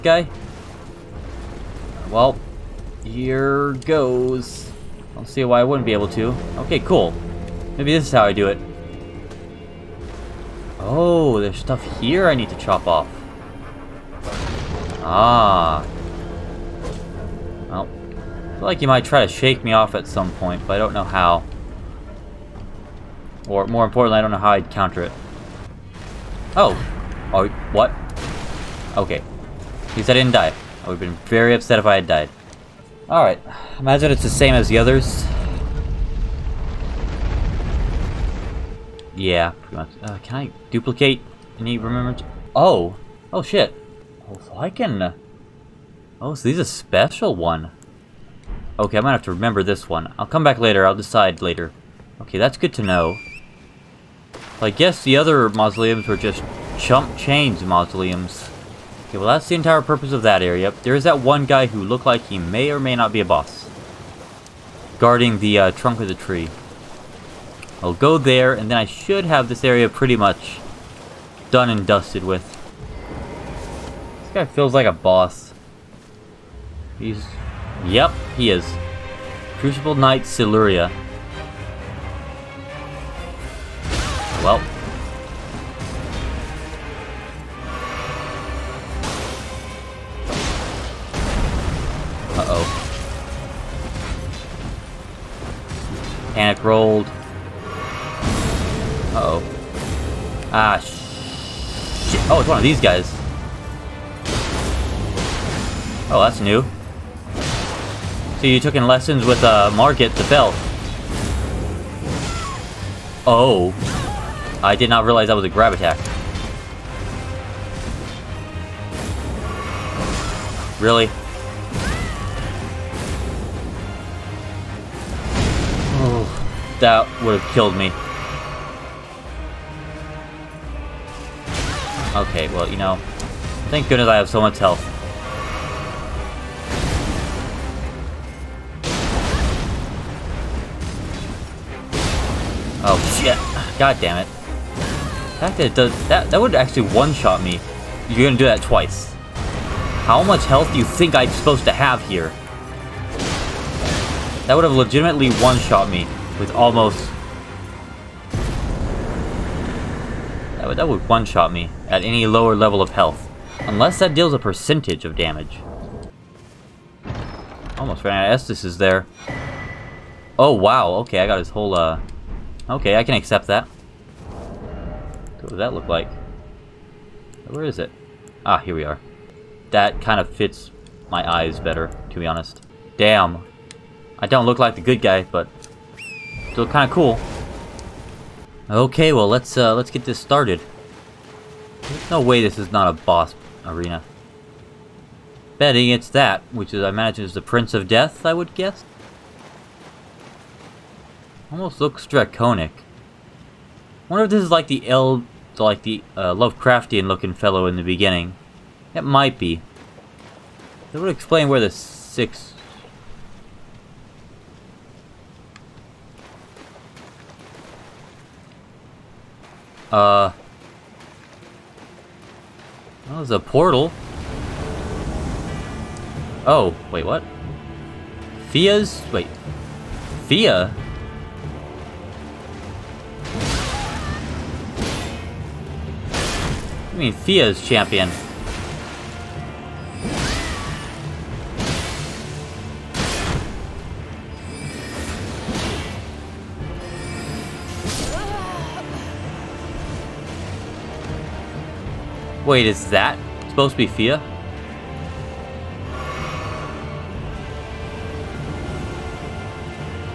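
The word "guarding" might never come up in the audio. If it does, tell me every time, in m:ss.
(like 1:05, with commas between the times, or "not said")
1:04.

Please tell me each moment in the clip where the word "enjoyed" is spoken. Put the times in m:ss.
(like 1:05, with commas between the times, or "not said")
not said.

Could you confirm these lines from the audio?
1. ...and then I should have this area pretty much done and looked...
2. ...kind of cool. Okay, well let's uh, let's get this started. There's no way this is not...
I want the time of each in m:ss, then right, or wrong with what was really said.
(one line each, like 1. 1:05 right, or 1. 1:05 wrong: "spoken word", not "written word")
1. 1:08 wrong: "dusted", not "looked"
2. 3:06 right.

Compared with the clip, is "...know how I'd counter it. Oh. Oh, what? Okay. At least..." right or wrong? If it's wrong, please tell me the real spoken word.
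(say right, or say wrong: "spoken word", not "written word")
right.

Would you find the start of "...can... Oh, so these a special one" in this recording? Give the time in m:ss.
0:44.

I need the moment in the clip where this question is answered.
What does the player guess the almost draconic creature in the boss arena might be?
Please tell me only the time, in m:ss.
3:17.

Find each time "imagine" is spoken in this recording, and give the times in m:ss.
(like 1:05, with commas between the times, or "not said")
0:33, 3:16.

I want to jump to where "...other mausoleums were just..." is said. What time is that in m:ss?
0:55.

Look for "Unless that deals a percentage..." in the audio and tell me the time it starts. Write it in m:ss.
2:43.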